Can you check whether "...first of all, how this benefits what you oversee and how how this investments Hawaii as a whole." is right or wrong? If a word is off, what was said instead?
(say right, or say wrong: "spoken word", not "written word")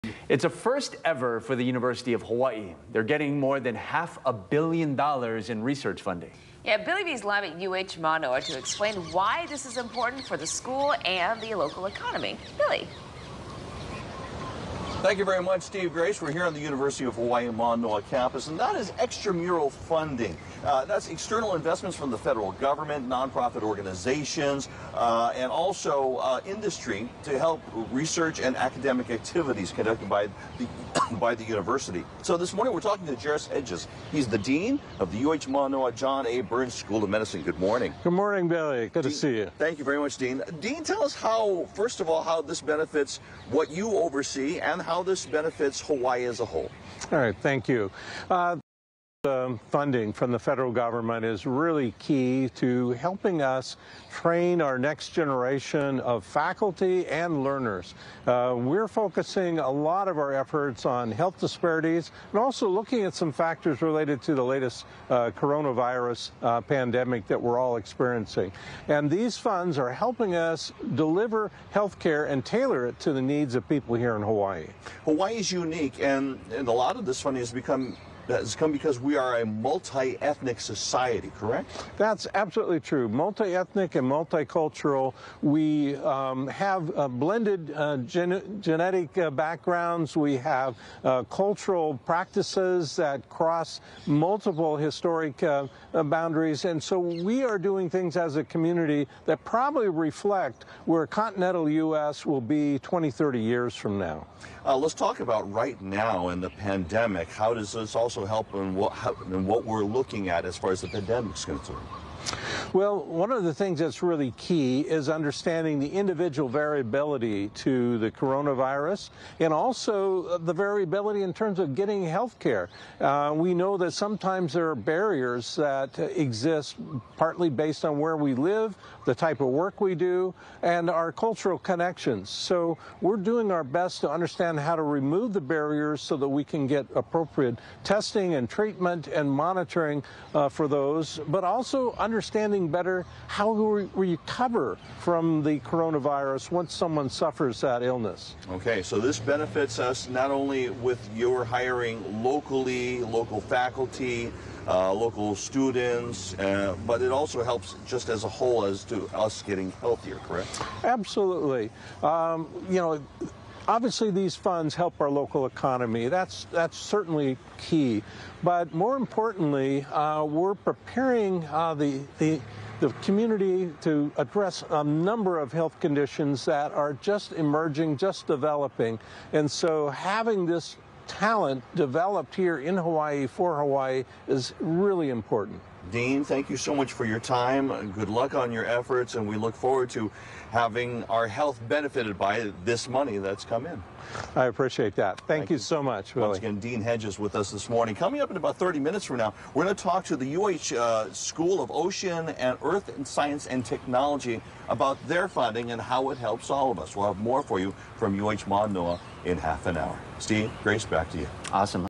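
wrong: "benefits", not "investments".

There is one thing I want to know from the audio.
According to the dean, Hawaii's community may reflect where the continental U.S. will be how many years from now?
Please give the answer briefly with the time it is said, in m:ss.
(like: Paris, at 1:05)
20, 30 years, at 1:42.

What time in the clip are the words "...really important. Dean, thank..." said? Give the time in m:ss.
3:04.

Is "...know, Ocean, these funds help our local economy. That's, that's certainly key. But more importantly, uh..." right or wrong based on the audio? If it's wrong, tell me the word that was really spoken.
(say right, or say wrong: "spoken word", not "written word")
wrong: "Obviously", not "Ocean".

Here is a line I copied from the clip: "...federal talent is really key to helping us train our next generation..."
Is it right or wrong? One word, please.
wrong.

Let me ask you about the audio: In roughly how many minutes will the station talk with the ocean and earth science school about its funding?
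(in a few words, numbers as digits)
30 minutes.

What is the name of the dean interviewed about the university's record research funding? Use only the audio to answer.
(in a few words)
Jerris Hedges.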